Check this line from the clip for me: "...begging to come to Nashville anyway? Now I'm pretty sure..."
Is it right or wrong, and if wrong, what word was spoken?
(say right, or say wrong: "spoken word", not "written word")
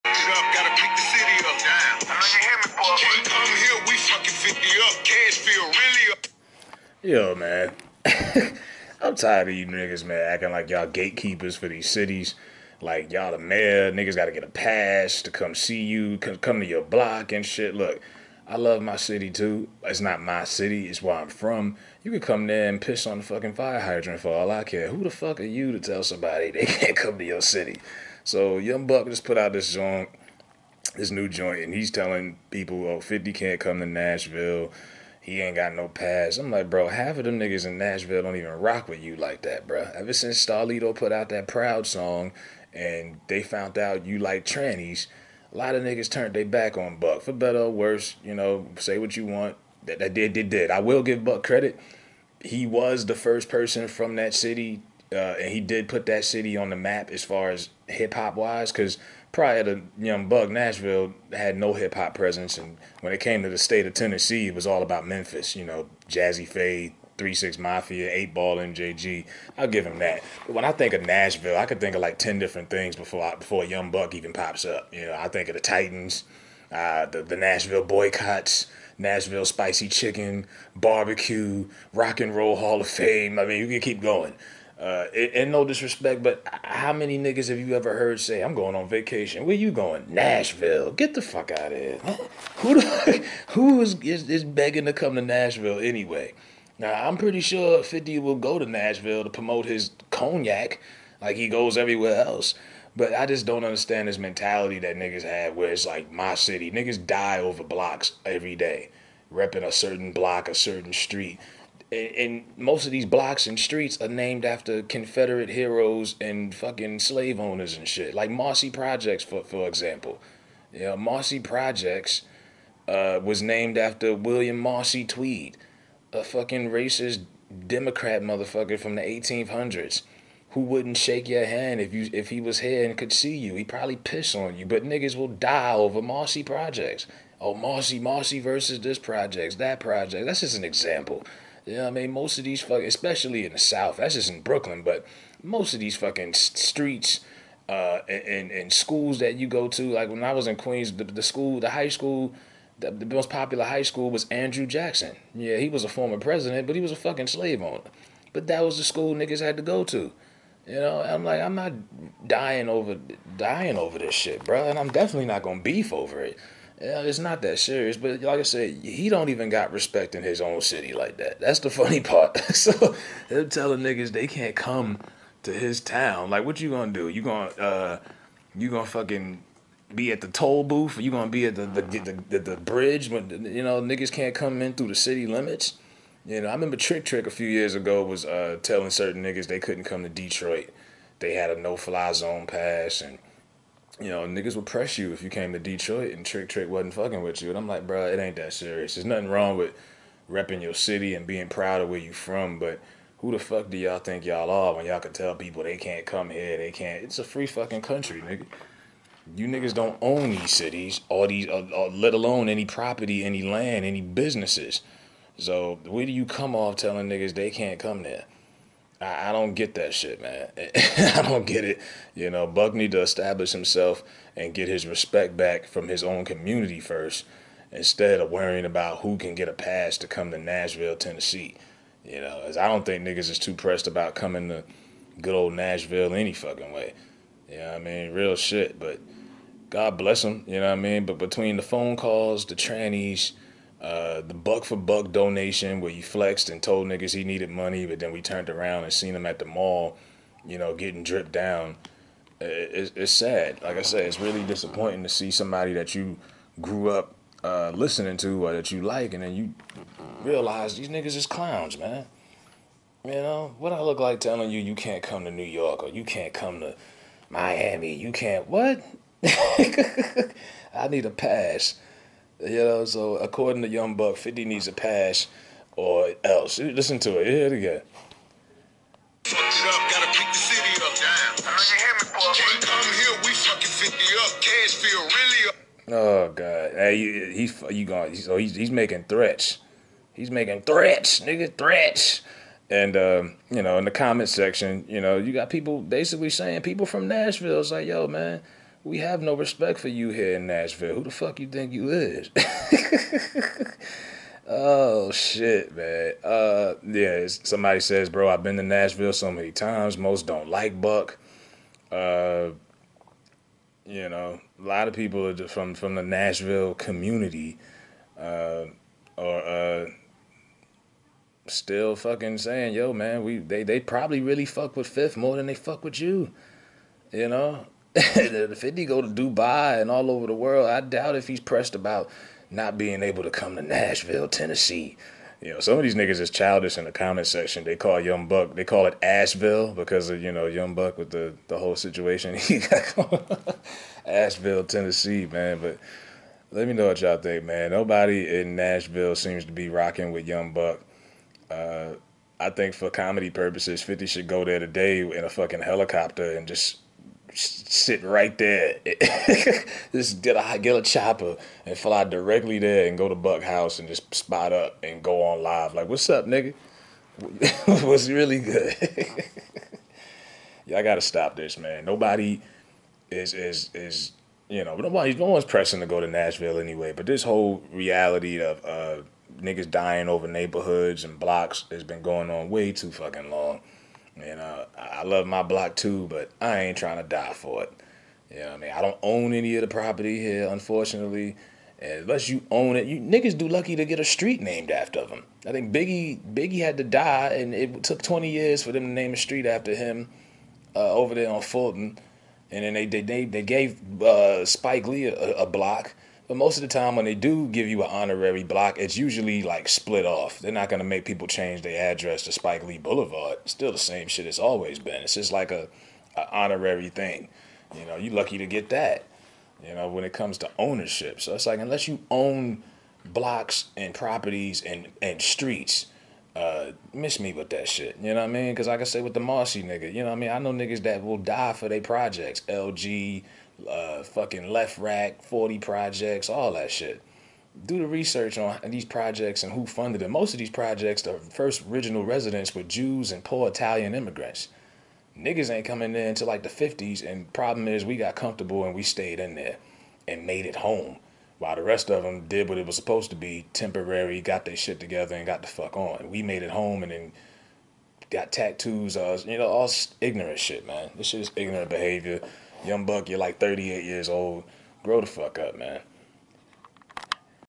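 right.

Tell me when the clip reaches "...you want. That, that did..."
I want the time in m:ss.
0:49.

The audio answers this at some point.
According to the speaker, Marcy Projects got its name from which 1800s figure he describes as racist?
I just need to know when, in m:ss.
2:04.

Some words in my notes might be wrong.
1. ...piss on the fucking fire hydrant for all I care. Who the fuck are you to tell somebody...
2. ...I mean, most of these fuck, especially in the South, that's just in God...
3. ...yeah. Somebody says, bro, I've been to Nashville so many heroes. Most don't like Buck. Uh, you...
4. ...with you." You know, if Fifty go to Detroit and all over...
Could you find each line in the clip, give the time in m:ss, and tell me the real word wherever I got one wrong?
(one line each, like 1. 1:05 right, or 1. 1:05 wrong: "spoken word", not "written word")
1. 0:22 right
2. 2:21 wrong: "Brooklyn", not "God"
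3. 5:06 wrong: "times", not "heroes"
4. 5:25 wrong: "Dubai", not "Detroit".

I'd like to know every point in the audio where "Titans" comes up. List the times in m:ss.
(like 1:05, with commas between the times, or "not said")
1:15.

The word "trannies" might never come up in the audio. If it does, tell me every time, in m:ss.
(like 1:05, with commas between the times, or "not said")
0:44, 4:02.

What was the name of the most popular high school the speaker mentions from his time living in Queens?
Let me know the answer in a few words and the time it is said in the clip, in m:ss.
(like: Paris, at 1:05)
Andrew Jackson, at 2:34.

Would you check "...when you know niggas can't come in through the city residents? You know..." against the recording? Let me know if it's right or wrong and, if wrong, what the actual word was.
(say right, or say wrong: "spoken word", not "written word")
wrong: "limits", not "residents".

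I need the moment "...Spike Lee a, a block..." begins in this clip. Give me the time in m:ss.
6:44.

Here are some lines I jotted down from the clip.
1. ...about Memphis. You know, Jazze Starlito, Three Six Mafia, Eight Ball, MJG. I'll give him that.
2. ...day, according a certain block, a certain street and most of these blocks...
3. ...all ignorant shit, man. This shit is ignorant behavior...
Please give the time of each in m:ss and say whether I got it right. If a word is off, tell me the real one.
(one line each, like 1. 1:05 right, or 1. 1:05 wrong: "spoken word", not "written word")
1. 1:04 wrong: "Pha", not "Starlito"
2. 1:48 wrong: "repping", not "according"
3. 7:39 right.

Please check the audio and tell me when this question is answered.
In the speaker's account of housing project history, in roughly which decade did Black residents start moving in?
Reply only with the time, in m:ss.
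7:26.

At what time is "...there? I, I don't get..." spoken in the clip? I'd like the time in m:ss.
3:38.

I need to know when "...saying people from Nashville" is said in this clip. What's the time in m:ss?
4:56.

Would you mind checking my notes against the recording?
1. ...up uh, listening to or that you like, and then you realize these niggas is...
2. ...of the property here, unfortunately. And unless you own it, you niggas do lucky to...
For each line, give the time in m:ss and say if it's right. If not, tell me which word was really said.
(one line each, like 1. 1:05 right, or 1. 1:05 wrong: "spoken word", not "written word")
1. 4:16 right
2. 6:29 right.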